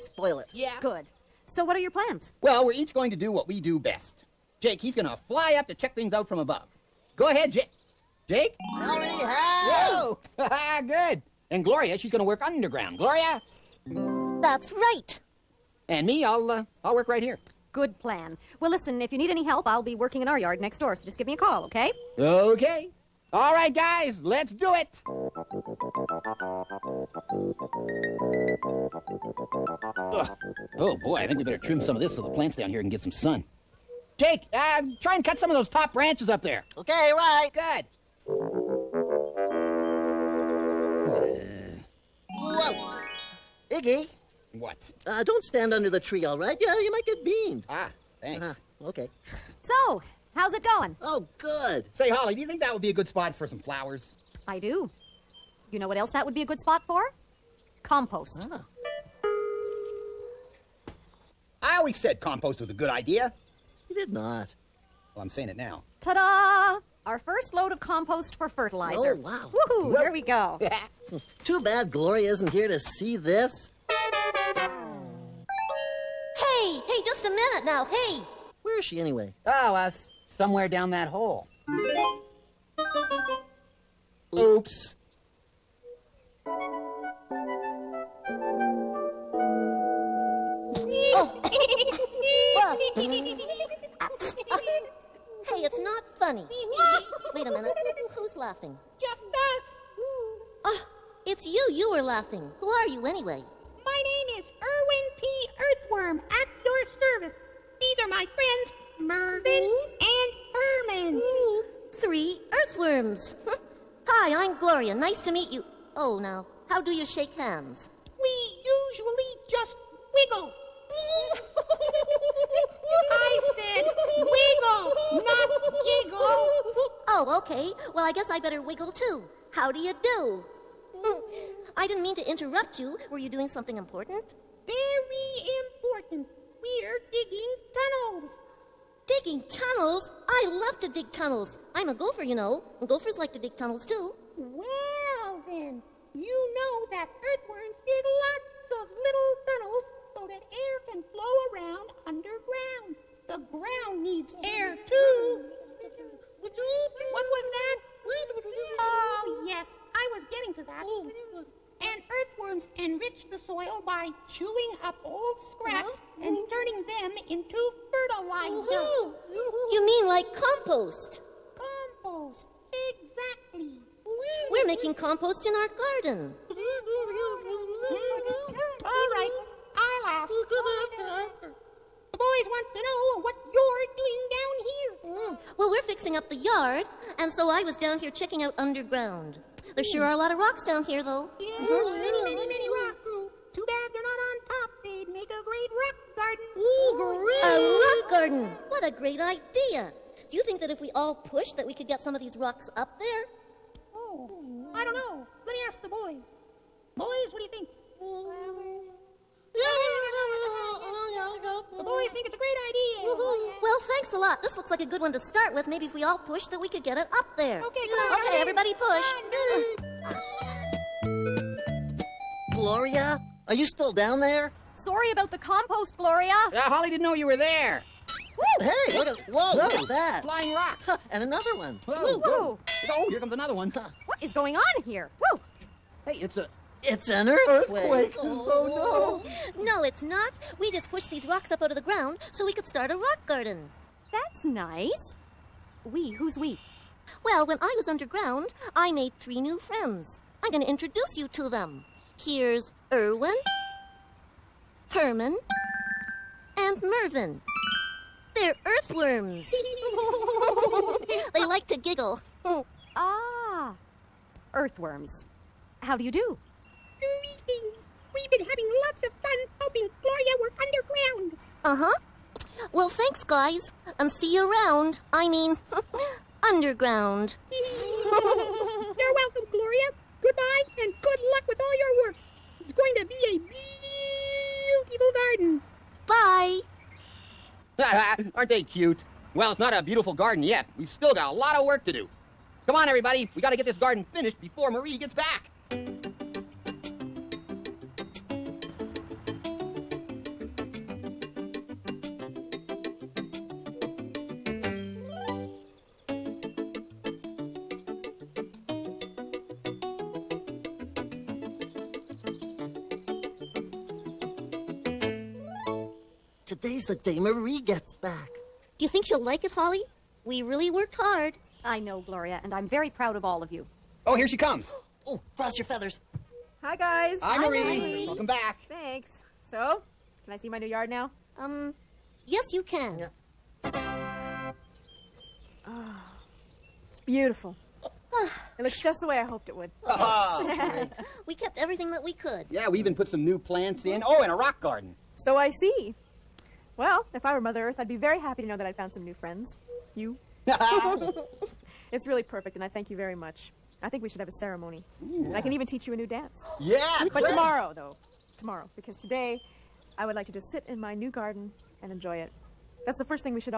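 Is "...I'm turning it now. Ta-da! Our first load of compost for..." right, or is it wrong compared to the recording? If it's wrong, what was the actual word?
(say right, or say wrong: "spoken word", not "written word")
wrong: "saying", not "turning".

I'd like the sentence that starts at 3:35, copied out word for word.
Maybe if we all push, that we could get it up there.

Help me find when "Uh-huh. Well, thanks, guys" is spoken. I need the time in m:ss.
4:31.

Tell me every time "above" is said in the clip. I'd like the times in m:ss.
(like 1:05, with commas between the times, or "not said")
0:06.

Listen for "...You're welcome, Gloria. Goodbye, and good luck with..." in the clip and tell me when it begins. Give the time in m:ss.
4:37.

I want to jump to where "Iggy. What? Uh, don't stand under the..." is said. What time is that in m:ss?
0:43.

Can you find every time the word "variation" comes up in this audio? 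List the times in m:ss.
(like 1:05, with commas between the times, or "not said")
not said.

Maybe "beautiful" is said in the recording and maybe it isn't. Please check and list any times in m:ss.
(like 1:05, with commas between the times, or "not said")
4:44, 4:49, 5:36.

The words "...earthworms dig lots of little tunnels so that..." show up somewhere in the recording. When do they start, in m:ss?
2:27.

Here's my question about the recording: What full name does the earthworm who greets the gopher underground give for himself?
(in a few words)
Erwin P. Earthworm.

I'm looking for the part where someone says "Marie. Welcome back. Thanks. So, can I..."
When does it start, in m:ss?
5:27.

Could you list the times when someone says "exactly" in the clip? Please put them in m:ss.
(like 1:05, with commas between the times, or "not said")
2:52.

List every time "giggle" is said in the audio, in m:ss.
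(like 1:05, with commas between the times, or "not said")
2:05, 4:21.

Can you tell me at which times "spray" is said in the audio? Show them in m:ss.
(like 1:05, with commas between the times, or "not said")
not said.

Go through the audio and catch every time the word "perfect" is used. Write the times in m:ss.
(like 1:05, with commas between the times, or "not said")
5:52.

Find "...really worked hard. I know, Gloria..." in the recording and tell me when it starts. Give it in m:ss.
5:20.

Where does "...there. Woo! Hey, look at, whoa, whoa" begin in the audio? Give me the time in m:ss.
3:47.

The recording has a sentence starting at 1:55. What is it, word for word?
Oh, now, how do you shake hands?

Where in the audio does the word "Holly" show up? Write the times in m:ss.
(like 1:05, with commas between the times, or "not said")
0:52, 3:46, 5:19.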